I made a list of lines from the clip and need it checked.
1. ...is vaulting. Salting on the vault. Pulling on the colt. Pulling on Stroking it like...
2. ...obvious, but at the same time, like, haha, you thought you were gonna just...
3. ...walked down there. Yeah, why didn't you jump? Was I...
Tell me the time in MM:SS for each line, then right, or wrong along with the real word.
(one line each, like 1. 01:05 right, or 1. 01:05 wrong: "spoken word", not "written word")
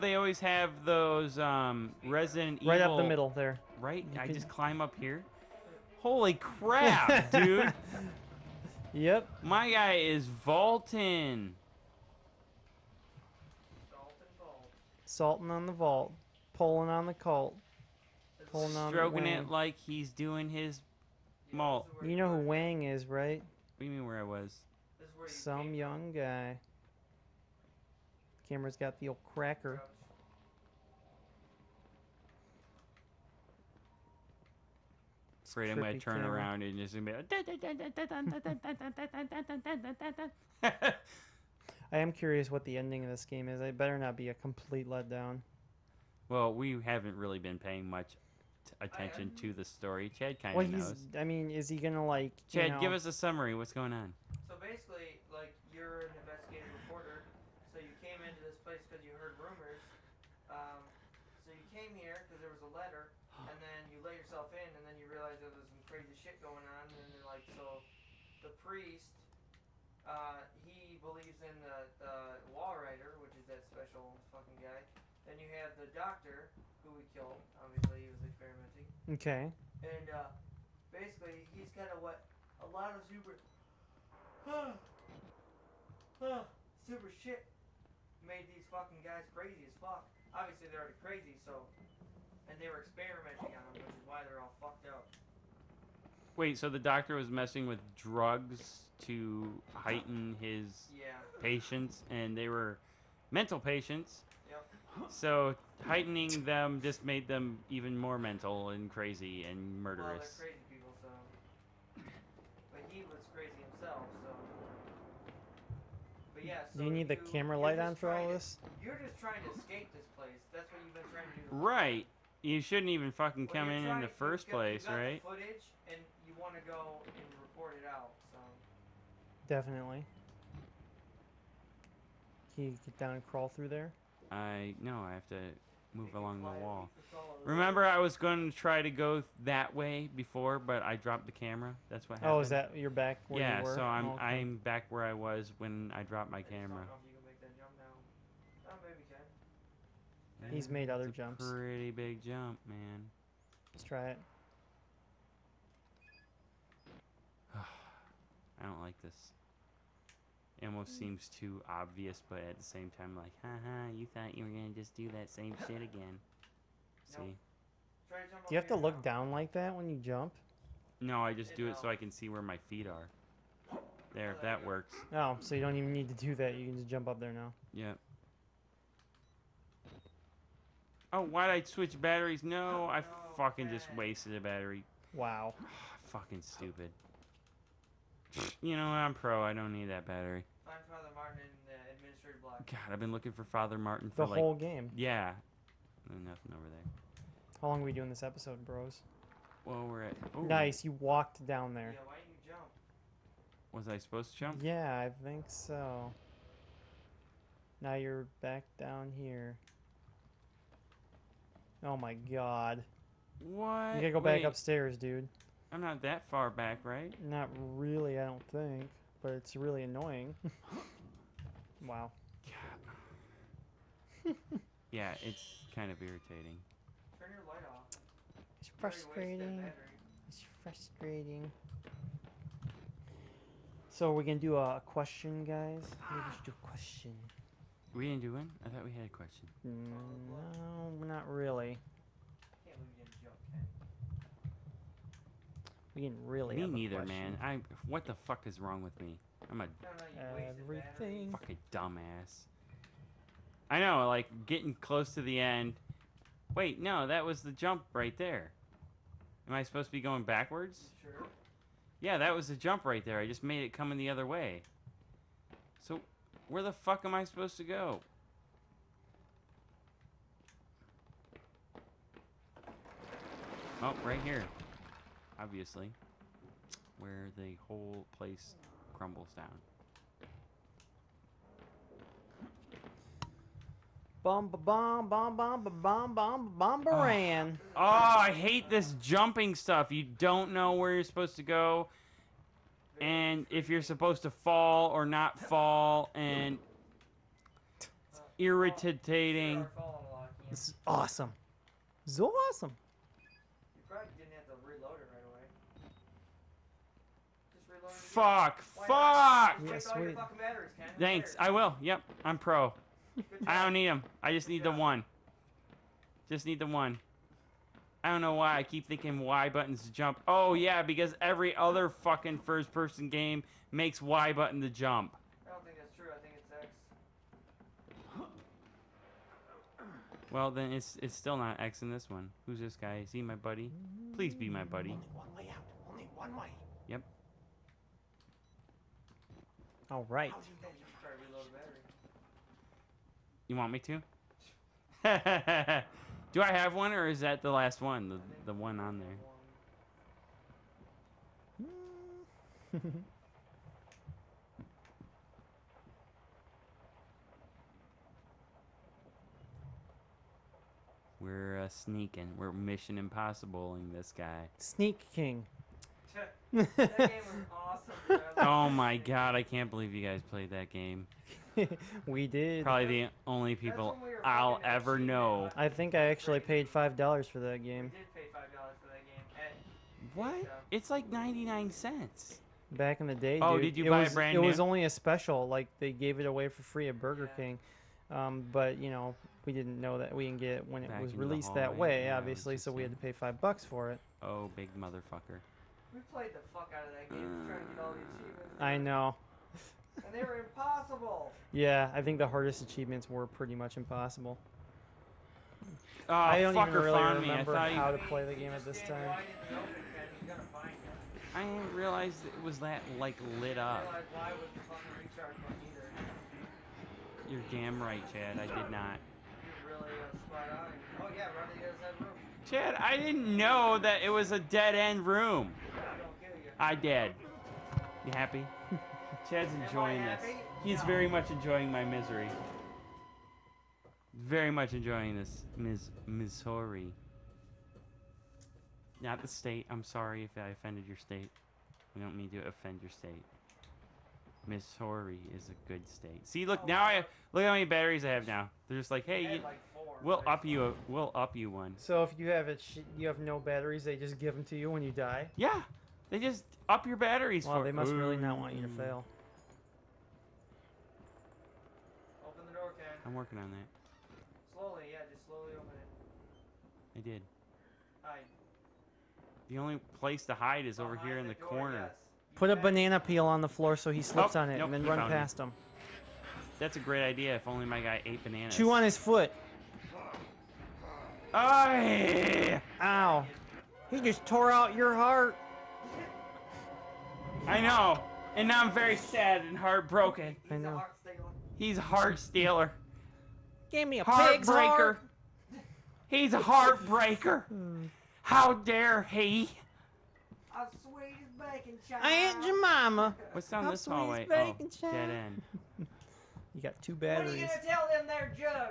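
1. 00:09 right
2. 02:41 right
3. 03:20 right.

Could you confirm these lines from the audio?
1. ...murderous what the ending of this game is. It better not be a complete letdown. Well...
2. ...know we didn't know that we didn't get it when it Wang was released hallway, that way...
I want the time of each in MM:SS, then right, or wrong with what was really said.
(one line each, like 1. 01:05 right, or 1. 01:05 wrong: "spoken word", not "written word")
1. 00:42 wrong: "curious", not "murderous"
2. 06:28 wrong: "Back", not "Wang".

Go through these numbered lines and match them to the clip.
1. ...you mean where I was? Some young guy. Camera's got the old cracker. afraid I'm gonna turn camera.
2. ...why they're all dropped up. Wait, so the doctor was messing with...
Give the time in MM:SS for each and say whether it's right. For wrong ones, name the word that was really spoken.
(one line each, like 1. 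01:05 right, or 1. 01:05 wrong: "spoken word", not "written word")
1. 00:23 right
2. 01:34 wrong: "fucked", not "dropped".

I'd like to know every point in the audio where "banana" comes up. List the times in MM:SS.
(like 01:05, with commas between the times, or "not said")
07:52, 07:58.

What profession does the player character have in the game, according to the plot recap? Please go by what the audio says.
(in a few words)
Investigative reporter.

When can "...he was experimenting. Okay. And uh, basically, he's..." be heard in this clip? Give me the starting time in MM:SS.
01:18.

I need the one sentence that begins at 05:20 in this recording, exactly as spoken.
Oh yeah, because every other fucking first person game makes Y button to jump.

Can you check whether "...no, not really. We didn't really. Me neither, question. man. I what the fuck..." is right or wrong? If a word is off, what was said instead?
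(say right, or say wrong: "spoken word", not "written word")
right.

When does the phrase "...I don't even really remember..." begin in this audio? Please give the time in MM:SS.
06:46.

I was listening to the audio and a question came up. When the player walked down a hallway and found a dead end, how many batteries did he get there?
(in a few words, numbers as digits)
2.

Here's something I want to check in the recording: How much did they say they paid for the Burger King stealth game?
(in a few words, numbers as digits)
5 dollars.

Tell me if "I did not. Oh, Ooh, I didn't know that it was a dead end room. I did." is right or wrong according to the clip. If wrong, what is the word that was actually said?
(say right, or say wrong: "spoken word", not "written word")
wrong: "Chad", not "Ooh".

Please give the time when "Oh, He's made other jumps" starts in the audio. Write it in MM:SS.
02:26.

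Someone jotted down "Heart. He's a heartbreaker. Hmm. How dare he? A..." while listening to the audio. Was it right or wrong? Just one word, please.
right.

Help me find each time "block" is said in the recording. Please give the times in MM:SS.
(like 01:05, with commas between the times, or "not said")
03:12.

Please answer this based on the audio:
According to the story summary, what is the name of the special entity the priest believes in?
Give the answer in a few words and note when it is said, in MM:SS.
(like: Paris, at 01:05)
The Walrider, at 01:12.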